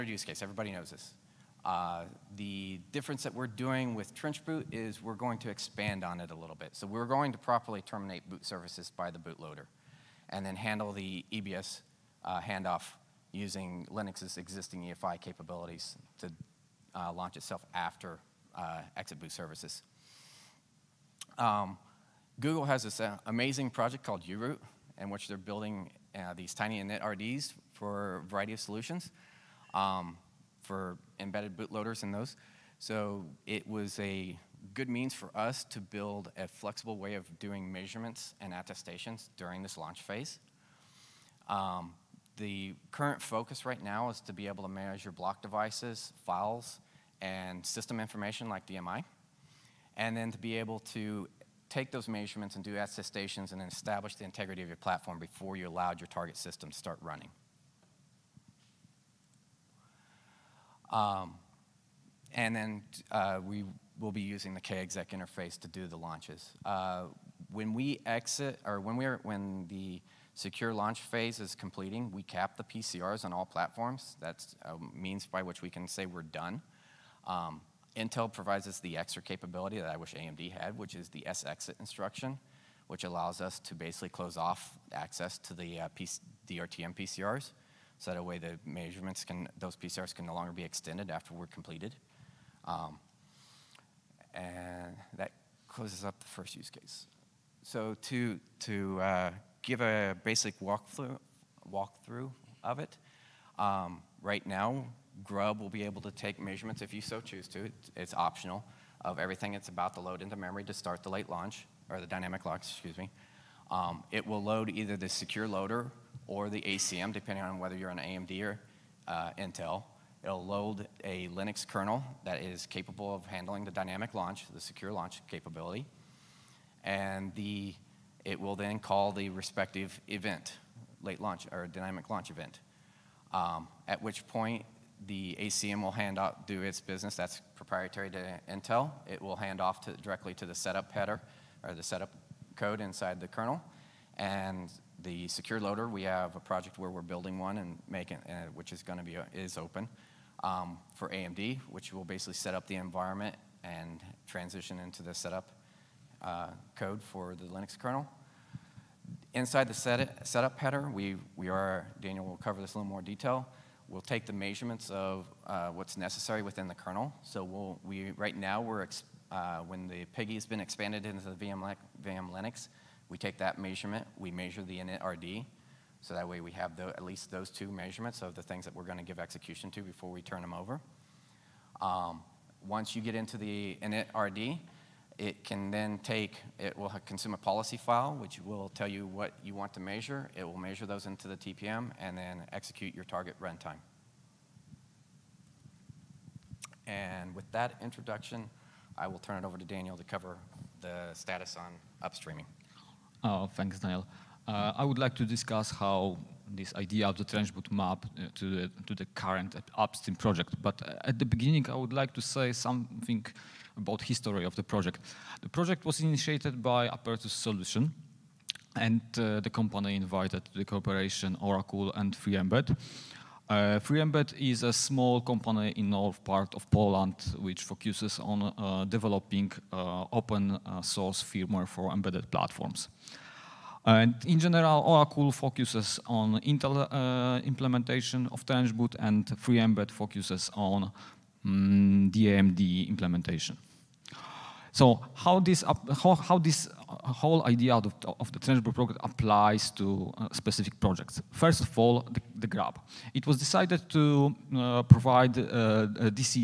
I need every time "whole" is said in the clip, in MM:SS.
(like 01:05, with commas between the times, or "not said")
04:07.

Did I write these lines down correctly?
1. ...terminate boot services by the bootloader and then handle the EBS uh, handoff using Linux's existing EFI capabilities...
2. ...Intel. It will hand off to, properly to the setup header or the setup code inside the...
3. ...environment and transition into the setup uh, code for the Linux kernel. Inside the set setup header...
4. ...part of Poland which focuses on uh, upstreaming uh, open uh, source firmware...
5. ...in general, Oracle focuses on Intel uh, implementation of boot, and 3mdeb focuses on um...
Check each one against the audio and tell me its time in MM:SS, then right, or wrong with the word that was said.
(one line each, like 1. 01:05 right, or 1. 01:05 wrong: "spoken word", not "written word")
1. 00:07 right
2. 02:18 wrong: "directly", not "properly"
3. 02:32 right
4. 03:46 wrong: "developing", not "upstreaming"
5. 03:54 right.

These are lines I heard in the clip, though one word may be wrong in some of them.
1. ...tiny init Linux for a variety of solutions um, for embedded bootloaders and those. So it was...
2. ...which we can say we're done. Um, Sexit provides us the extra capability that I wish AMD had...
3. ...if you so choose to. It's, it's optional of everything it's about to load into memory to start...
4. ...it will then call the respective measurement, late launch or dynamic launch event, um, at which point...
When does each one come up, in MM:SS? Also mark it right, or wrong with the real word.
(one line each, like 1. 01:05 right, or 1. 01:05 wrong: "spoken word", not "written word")
1. 00:26 wrong: "RDs", not "Linux"
2. 01:15 wrong: "Intel", not "Sexit"
3. 01:46 right
4. 02:08 wrong: "event", not "measurement".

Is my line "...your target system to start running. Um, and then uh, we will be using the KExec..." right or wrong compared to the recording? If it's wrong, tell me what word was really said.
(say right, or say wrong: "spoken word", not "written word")
right.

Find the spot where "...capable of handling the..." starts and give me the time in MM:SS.
02:02.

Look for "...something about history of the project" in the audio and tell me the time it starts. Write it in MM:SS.
03:32.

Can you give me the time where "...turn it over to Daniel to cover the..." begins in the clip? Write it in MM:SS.
03:19.